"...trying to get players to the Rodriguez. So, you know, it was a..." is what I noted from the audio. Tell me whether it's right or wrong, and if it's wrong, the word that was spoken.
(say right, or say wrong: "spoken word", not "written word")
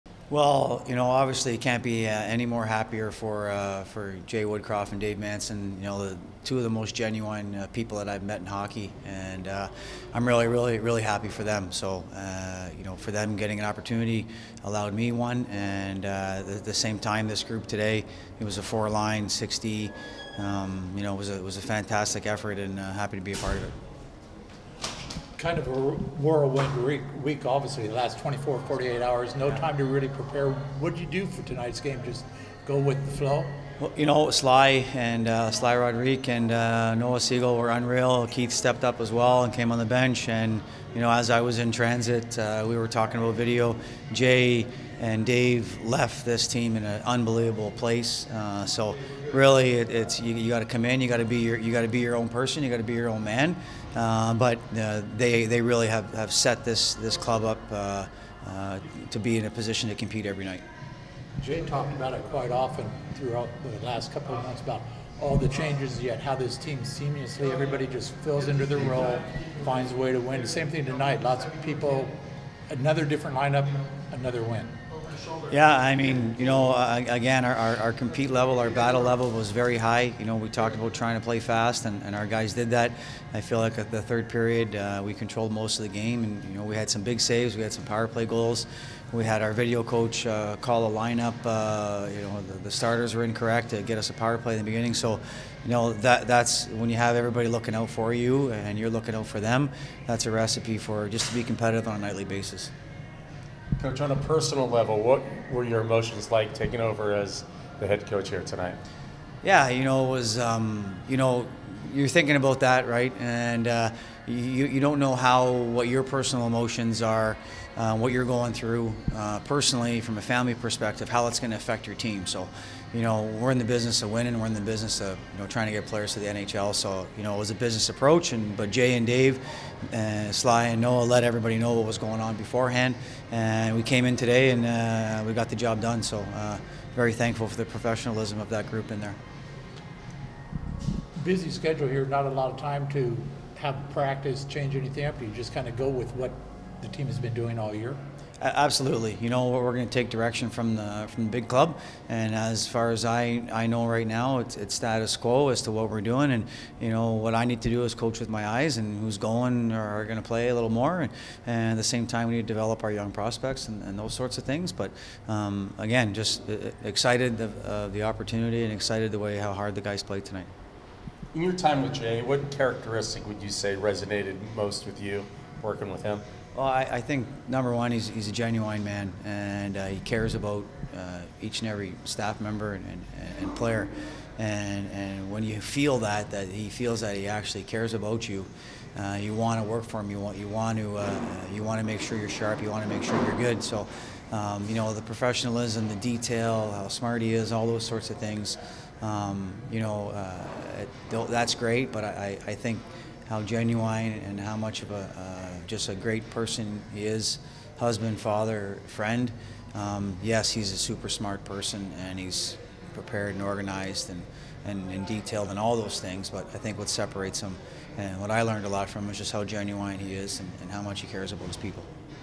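wrong: "NHL", not "Rodriguez".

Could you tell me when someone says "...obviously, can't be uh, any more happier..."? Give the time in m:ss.
0:01.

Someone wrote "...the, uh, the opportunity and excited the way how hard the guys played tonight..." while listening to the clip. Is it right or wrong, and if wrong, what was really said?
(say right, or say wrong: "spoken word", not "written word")
right.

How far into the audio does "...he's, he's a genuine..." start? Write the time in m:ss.
2:57.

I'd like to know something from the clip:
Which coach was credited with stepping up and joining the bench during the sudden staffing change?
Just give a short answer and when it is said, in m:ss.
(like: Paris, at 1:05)
Keith, at 0:38.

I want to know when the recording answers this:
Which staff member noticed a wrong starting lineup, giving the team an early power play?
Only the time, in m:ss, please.
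1:29.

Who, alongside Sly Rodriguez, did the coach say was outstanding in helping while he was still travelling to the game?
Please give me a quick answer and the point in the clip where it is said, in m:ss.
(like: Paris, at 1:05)
Noah Siegel, at 0:36.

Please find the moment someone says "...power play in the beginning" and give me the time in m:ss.
1:34.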